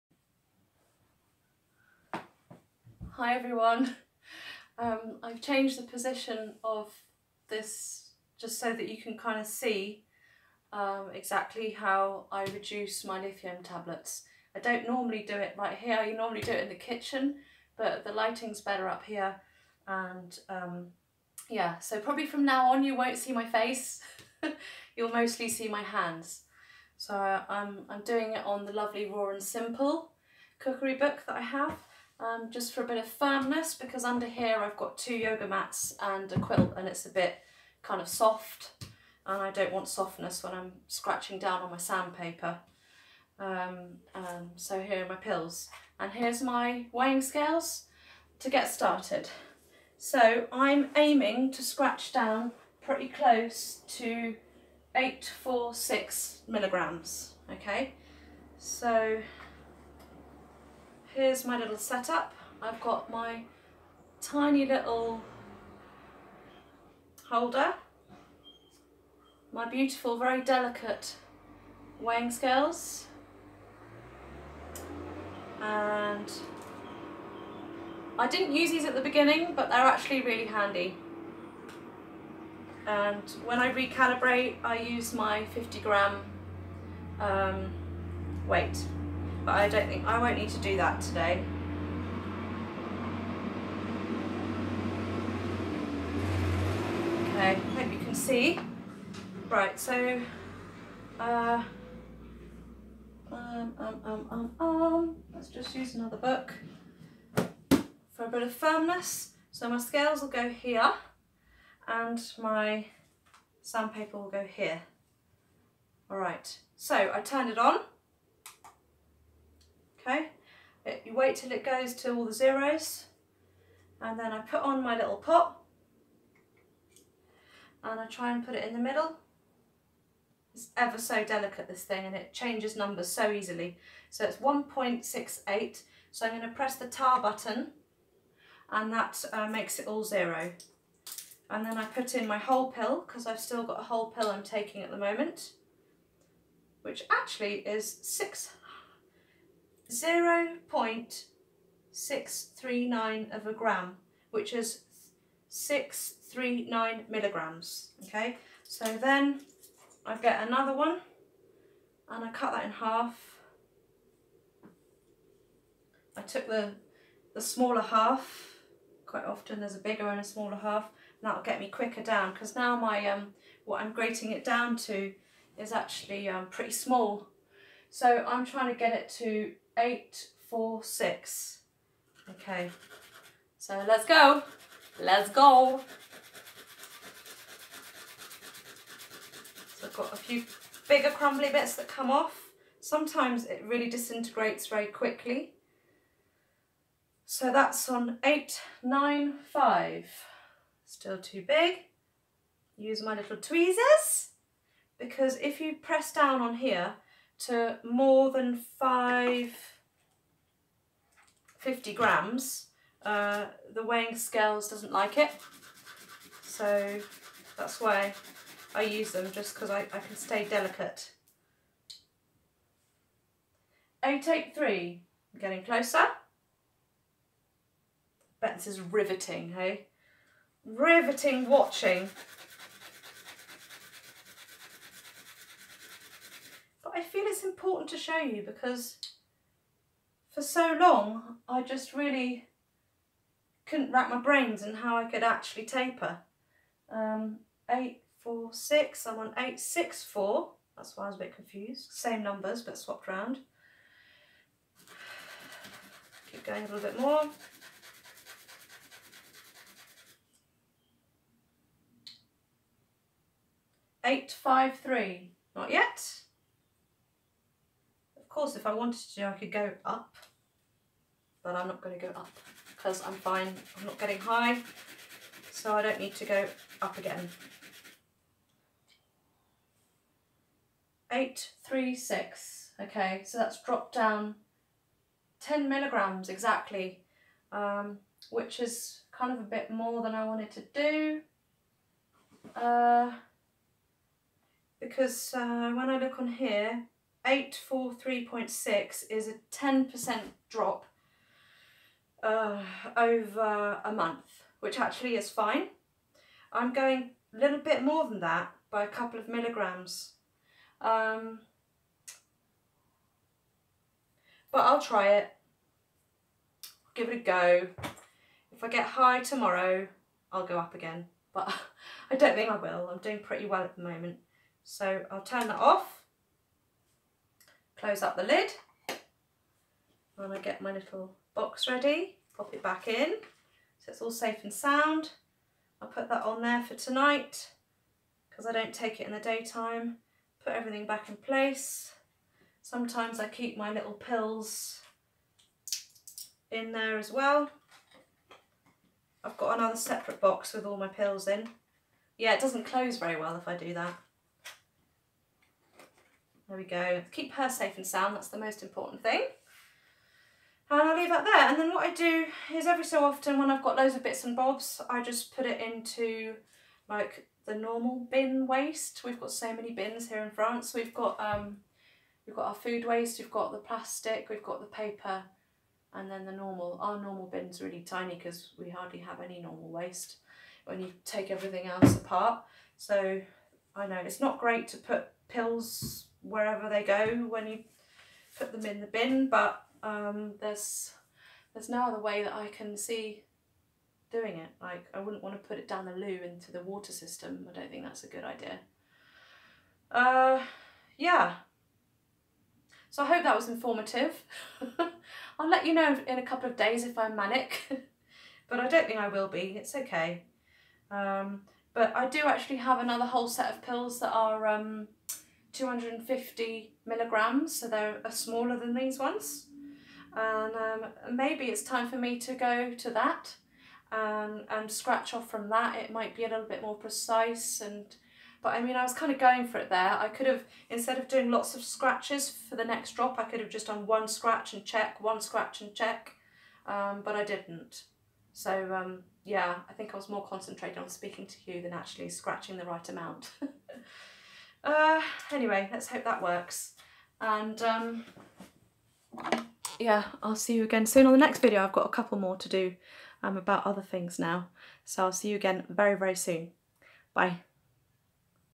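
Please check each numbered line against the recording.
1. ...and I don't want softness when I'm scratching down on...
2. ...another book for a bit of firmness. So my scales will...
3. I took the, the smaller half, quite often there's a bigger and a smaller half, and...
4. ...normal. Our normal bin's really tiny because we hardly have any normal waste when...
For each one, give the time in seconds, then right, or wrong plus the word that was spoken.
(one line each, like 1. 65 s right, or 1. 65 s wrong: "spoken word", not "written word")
1. 39 s right
2. 105 s right
3. 166 s right
4. 376 s right.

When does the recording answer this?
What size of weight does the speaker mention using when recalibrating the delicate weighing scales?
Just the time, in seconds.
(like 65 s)
85 s.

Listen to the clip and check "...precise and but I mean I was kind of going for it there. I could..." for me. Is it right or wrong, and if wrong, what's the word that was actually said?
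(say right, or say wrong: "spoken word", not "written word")
right.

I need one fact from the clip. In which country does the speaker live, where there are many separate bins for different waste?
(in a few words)
France.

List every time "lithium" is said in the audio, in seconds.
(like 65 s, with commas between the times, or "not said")
13 s.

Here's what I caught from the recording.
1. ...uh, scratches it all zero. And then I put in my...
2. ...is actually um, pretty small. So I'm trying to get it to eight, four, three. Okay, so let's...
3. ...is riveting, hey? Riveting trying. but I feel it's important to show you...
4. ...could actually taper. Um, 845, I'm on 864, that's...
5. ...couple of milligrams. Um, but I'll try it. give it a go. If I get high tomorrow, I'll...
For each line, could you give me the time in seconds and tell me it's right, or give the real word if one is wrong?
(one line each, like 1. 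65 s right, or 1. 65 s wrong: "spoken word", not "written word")
1. 139 s wrong: "makes", not "scratches"
2. 175 s wrong: "six", not "three"
3. 228 s wrong: "watching", not "trying"
4. 245 s wrong: "846", not "845"
5. 308 s right.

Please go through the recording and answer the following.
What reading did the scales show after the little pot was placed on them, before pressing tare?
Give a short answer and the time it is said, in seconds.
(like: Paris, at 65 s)
1.68, at 134 s.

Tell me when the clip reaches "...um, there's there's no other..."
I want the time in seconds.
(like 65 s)
389 s.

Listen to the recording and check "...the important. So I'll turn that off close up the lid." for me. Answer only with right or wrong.
wrong.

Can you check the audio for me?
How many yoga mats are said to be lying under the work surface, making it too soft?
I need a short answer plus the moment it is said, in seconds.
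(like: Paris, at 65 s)
2, at 34 s.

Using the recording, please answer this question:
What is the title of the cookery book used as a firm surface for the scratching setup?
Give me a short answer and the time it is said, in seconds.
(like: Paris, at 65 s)
Raw and Simple, at 29 s.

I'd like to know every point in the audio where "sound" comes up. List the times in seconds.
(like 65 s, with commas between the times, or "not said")
334 s, 357 s.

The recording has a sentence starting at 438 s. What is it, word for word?
So um, yeah, I think I was more concentrated on speaking to you than actually scratching the right amount.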